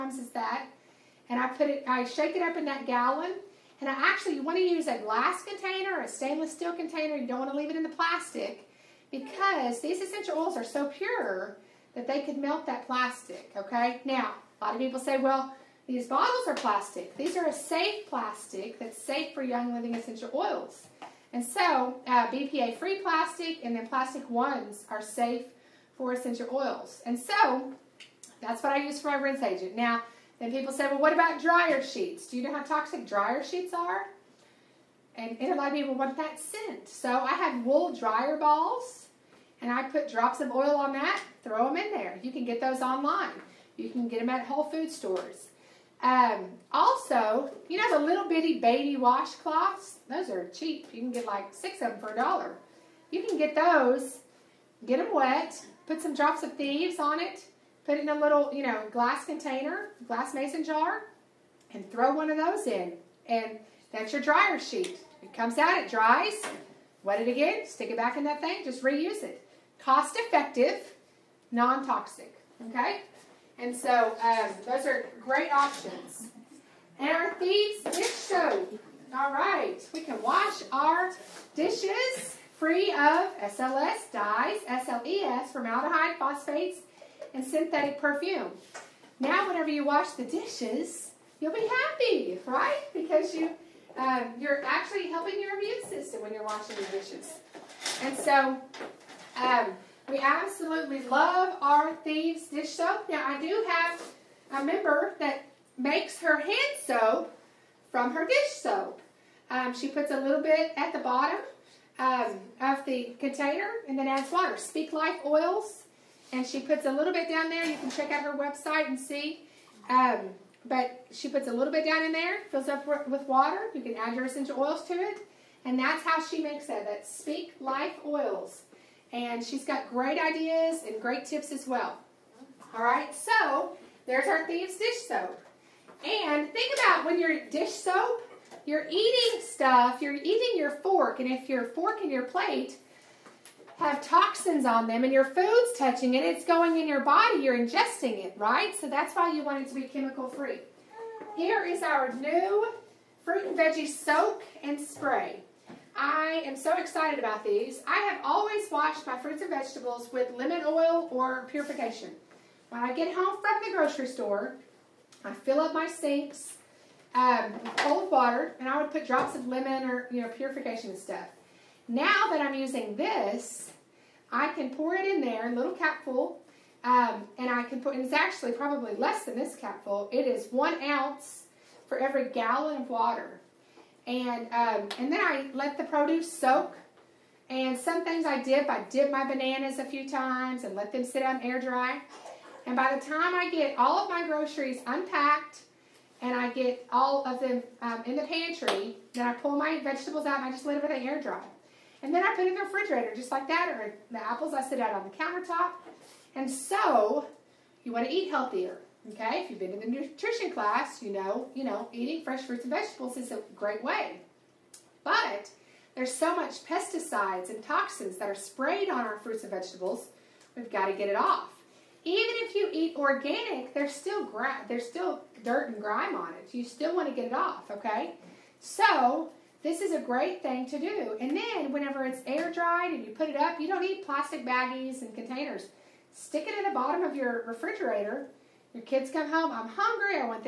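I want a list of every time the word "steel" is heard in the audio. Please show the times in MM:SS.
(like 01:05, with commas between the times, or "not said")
00:06.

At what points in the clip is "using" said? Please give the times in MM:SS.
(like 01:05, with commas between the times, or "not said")
02:52.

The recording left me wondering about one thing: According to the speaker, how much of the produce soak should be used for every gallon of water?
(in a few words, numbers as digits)
1 ounce.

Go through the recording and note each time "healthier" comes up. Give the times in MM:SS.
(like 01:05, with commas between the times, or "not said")
03:28.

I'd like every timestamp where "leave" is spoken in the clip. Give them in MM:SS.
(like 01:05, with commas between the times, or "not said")
00:07.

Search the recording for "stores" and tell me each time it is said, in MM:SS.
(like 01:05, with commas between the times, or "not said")
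00:44, 02:44.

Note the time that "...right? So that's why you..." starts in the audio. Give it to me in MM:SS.
02:28.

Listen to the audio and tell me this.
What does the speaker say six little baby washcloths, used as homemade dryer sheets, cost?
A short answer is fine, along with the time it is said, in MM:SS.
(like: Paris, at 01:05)
a dollar, at 00:52.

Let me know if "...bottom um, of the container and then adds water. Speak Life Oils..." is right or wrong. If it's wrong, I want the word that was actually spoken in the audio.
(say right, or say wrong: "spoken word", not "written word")
right.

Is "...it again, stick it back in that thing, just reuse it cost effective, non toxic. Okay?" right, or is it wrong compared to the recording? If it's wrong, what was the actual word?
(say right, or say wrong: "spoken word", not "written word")
right.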